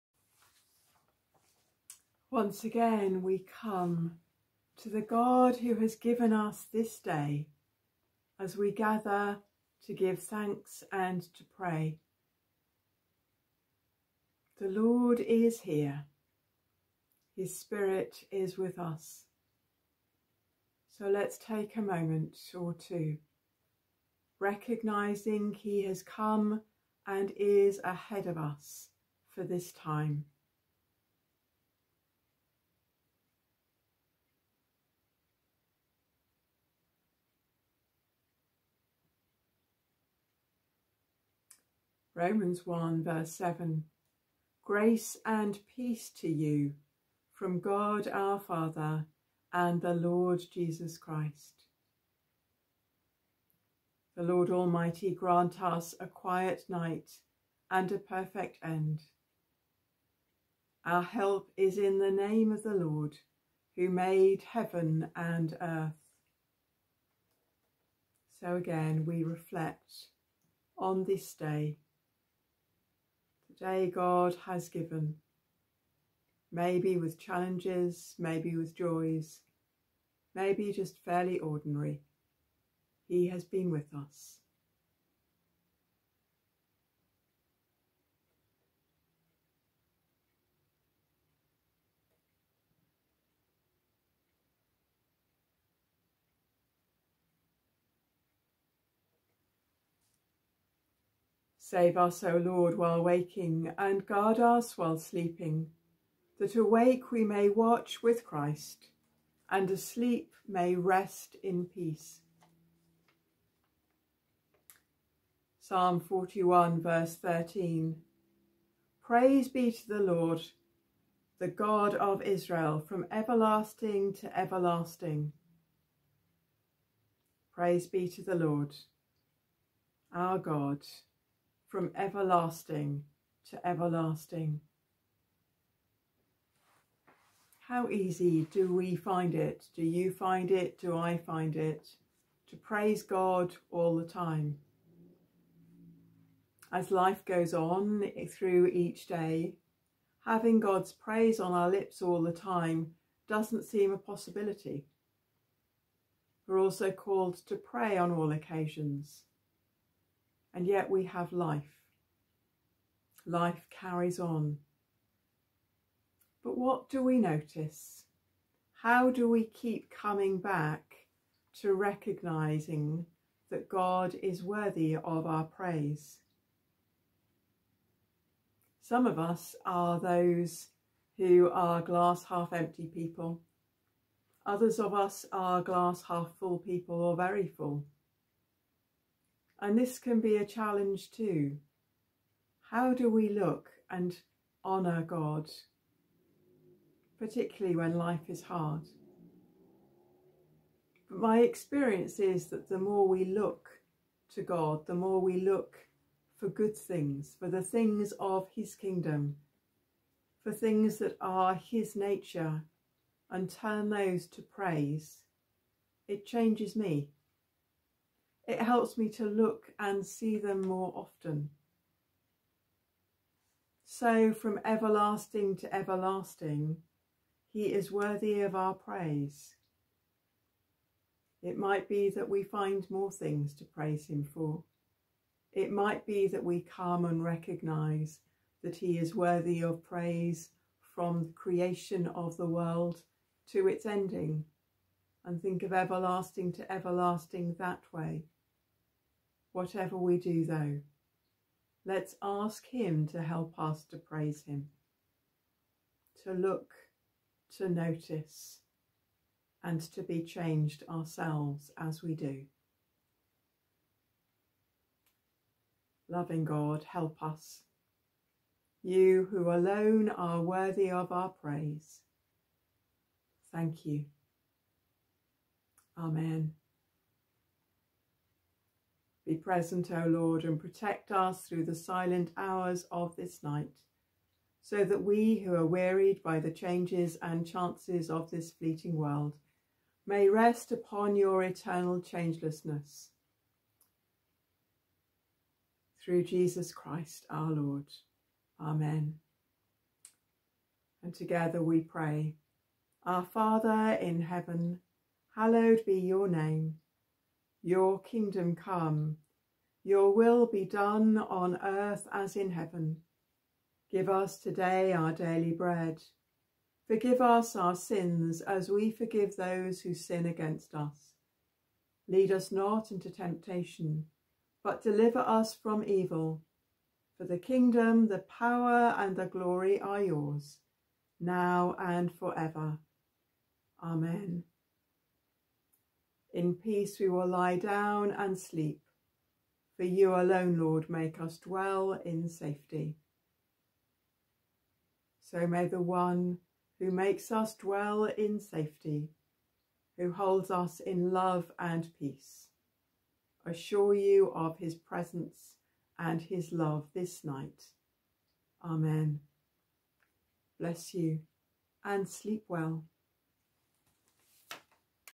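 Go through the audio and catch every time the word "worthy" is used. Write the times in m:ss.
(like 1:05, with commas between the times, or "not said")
2:54, 3:47, 3:59, 4:30.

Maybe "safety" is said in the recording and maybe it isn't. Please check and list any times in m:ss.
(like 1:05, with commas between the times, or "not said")
5:42, 5:48.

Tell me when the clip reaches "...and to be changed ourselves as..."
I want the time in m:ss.
4:19.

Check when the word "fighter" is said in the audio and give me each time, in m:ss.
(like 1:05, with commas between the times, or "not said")
not said.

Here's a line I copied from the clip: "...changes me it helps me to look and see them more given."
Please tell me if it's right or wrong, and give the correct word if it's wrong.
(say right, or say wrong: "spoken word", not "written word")
wrong: "often", not "given".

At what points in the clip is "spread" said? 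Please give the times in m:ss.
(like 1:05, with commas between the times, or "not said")
not said.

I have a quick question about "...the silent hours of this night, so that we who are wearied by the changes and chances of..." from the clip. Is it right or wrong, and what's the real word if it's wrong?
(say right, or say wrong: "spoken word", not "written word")
right.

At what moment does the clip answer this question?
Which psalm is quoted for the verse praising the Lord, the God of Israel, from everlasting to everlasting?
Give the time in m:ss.
1:55.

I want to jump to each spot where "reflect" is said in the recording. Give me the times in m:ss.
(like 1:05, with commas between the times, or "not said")
1:09.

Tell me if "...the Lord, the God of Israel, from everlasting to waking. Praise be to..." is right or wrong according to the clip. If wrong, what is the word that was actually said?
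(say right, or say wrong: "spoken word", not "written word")
wrong: "everlasting", not "waking".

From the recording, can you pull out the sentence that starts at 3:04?
Others of us are glass half full people or very full.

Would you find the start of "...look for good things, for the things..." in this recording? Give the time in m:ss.
3:25.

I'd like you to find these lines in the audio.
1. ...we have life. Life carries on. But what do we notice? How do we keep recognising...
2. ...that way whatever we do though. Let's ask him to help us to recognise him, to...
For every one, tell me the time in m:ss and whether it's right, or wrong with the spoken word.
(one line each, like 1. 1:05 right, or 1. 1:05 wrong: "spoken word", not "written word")
1. 2:40 wrong: "coming", not "recognising"
2. 4:07 wrong: "praise", not "recognise".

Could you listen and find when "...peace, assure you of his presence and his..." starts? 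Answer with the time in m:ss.
5:51.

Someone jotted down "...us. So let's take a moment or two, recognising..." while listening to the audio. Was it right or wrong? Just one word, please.
right.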